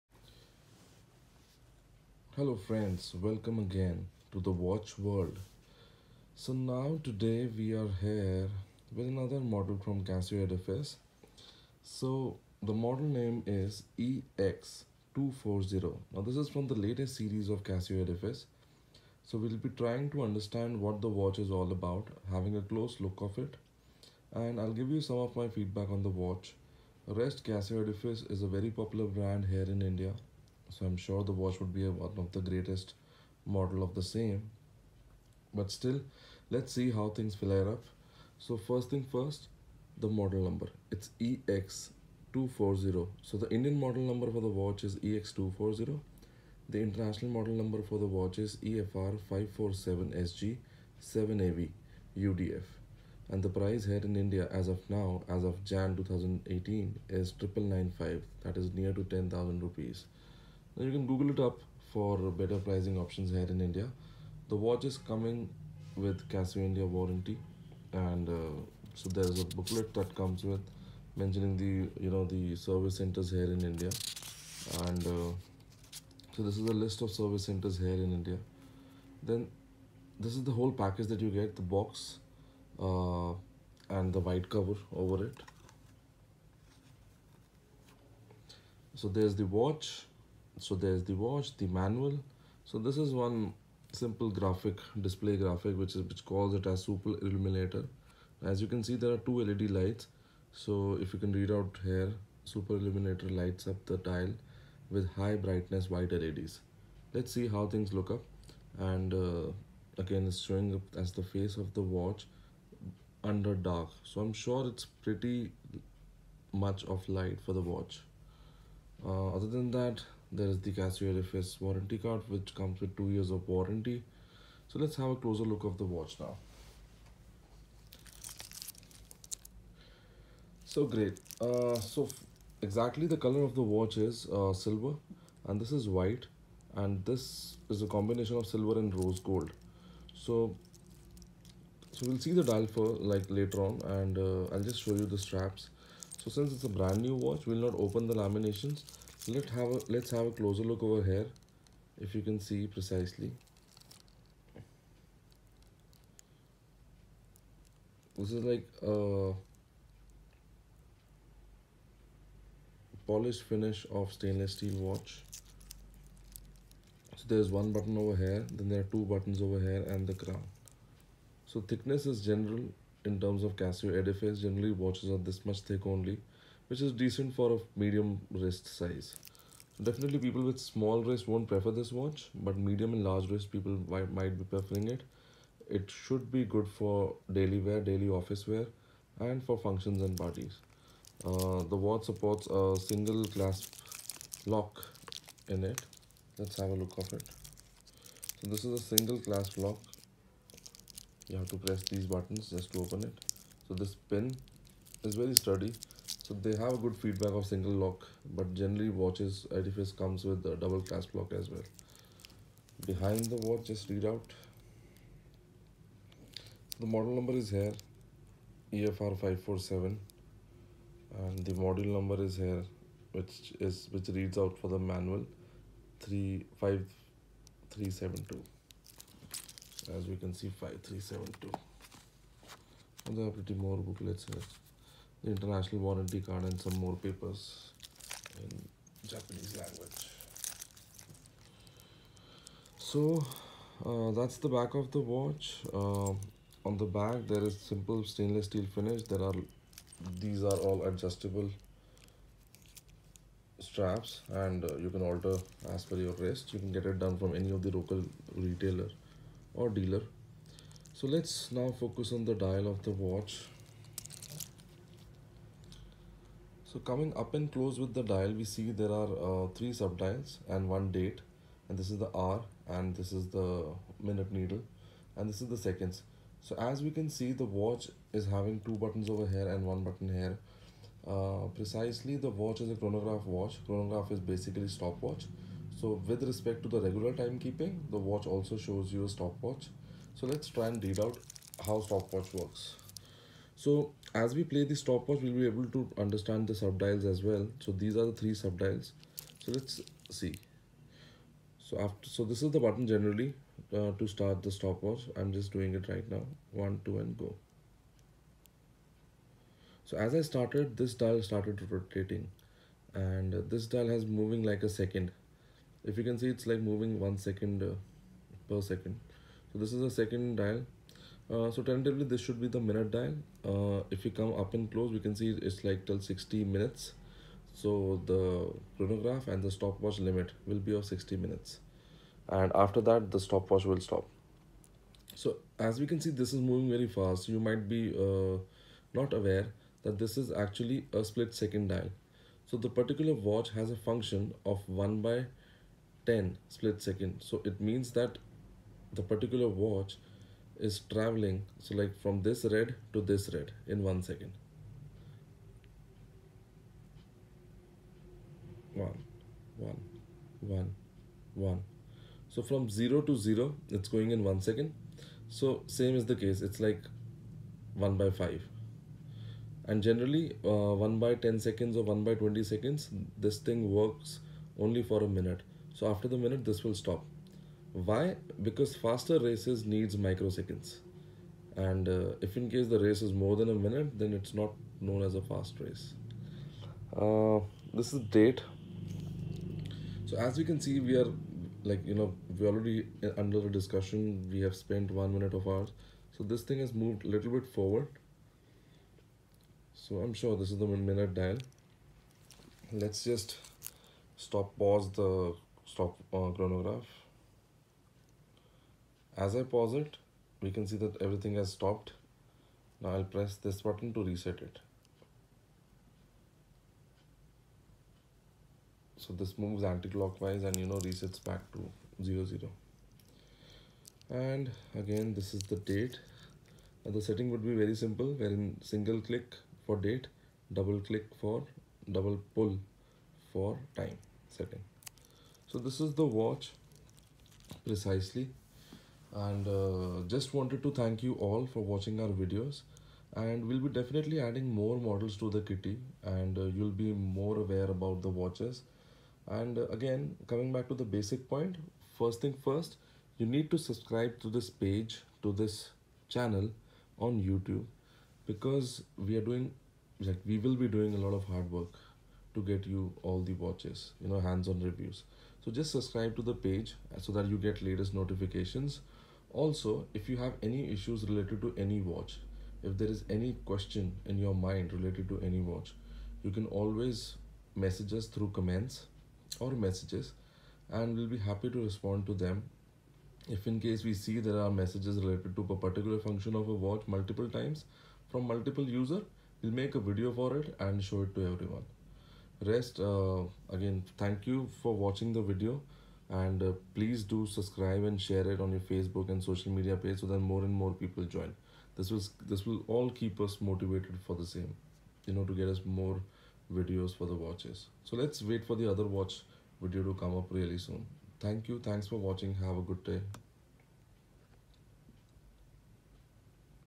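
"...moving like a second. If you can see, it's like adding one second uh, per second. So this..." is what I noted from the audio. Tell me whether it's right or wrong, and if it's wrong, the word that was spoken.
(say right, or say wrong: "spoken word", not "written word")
wrong: "moving", not "adding".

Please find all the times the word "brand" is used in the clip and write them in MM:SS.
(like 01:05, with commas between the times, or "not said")
00:29, 02:26.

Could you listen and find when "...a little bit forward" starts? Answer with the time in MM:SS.
06:37.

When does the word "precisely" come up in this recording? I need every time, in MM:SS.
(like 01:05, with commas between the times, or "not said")
02:32, 04:41, 07:17.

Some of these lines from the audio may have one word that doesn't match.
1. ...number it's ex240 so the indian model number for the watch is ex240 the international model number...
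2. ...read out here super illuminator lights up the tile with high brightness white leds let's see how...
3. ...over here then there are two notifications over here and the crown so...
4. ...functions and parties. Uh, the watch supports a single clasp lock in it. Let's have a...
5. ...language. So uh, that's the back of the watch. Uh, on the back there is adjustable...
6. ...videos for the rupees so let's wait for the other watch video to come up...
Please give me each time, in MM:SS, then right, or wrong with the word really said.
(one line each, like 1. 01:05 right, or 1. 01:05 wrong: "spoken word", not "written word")
1. 00:40 right
2. 01:41 right
3. 02:47 wrong: "buttons", not "notifications"
4. 03:09 right
5. 03:59 wrong: "simple", not "adjustable"
6. 08:26 wrong: "watches", not "rupees".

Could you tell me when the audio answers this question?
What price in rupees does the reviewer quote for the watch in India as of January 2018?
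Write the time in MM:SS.
00:57.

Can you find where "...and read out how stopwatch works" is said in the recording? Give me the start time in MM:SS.
04:50.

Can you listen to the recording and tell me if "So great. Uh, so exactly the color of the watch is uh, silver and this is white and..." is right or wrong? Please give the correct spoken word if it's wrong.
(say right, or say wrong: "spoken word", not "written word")
right.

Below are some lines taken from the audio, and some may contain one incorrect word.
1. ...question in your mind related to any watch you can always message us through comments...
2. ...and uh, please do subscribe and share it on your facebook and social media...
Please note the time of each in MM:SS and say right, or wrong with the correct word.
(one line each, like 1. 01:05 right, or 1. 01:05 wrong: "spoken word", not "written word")
1. 07:53 right
2. 08:16 right.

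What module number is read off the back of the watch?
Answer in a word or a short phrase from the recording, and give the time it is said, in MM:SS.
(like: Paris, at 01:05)
5372, at 03:50.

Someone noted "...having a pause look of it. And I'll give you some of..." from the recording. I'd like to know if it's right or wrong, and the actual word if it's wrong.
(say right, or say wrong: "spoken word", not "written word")
wrong: "close", not "pause".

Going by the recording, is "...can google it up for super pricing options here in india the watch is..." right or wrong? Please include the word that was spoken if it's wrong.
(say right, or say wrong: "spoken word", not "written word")
wrong: "better", not "super".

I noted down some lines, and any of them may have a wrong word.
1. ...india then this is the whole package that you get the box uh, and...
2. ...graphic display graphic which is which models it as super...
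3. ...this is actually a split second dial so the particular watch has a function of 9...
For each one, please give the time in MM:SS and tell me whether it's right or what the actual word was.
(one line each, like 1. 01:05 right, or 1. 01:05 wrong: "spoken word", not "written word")
1. 01:18 right
2. 01:34 wrong: "calls", not "models"
3. 05:39 wrong: "1", not "9".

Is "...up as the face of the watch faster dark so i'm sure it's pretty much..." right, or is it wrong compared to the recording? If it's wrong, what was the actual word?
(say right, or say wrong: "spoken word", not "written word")
wrong: "under", not "faster".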